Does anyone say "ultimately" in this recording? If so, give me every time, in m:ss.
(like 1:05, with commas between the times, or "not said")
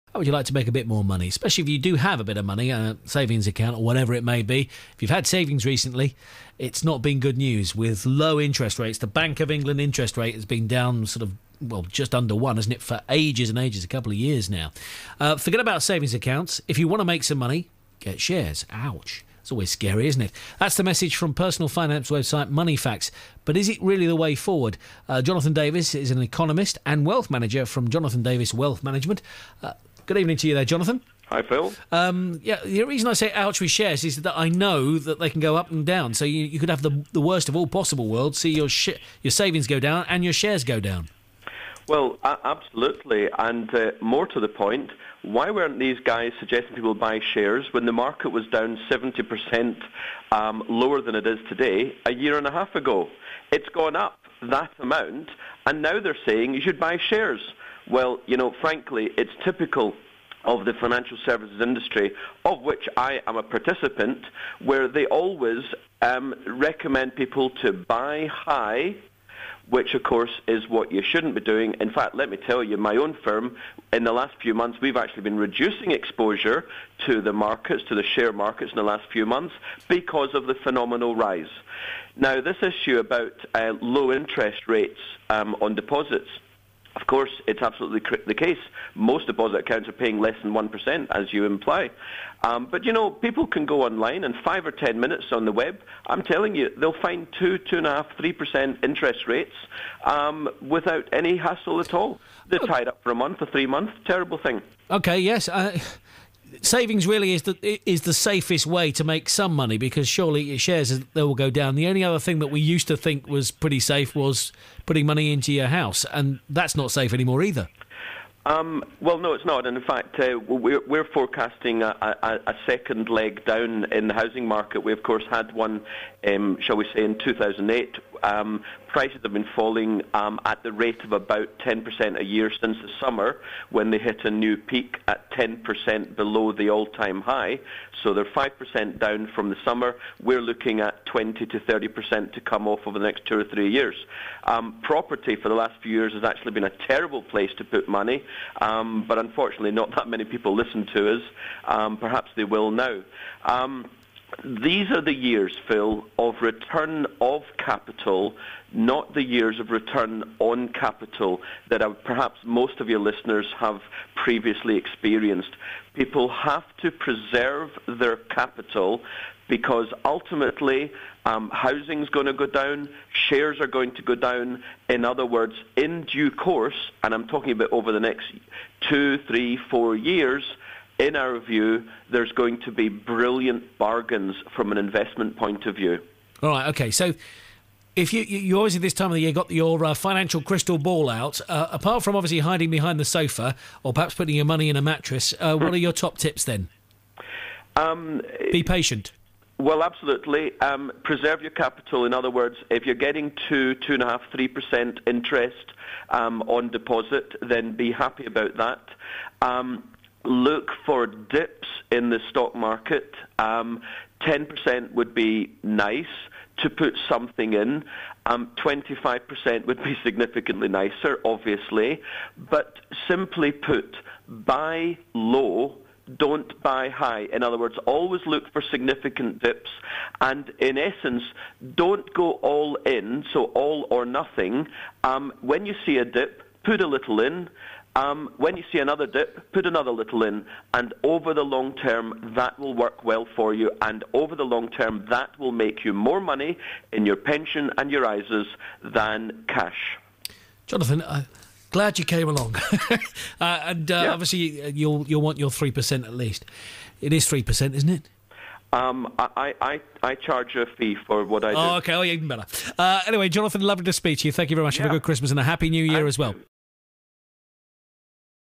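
2:50.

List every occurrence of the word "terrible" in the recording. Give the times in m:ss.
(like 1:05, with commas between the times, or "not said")
1:44, 2:26.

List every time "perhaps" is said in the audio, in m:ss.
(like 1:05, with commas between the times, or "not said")
2:31, 2:42, 3:13.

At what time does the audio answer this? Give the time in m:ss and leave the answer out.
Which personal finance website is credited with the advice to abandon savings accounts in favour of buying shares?
0:22.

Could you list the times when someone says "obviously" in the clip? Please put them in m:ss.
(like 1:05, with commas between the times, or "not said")
3:12, 3:41, 4:14.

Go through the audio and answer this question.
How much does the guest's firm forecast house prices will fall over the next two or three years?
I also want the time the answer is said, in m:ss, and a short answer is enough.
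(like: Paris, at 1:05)
20 to 30%, at 2:21.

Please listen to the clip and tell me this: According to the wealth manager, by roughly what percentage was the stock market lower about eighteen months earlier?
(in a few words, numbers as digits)
70%.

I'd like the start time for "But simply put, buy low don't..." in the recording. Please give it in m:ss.
3:42.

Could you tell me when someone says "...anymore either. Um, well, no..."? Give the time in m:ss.
1:57.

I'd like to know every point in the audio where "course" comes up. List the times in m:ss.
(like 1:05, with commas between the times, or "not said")
1:10, 1:27, 2:05, 2:56.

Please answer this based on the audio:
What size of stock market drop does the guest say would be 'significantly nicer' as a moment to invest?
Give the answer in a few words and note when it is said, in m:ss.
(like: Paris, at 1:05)
25%, at 3:38.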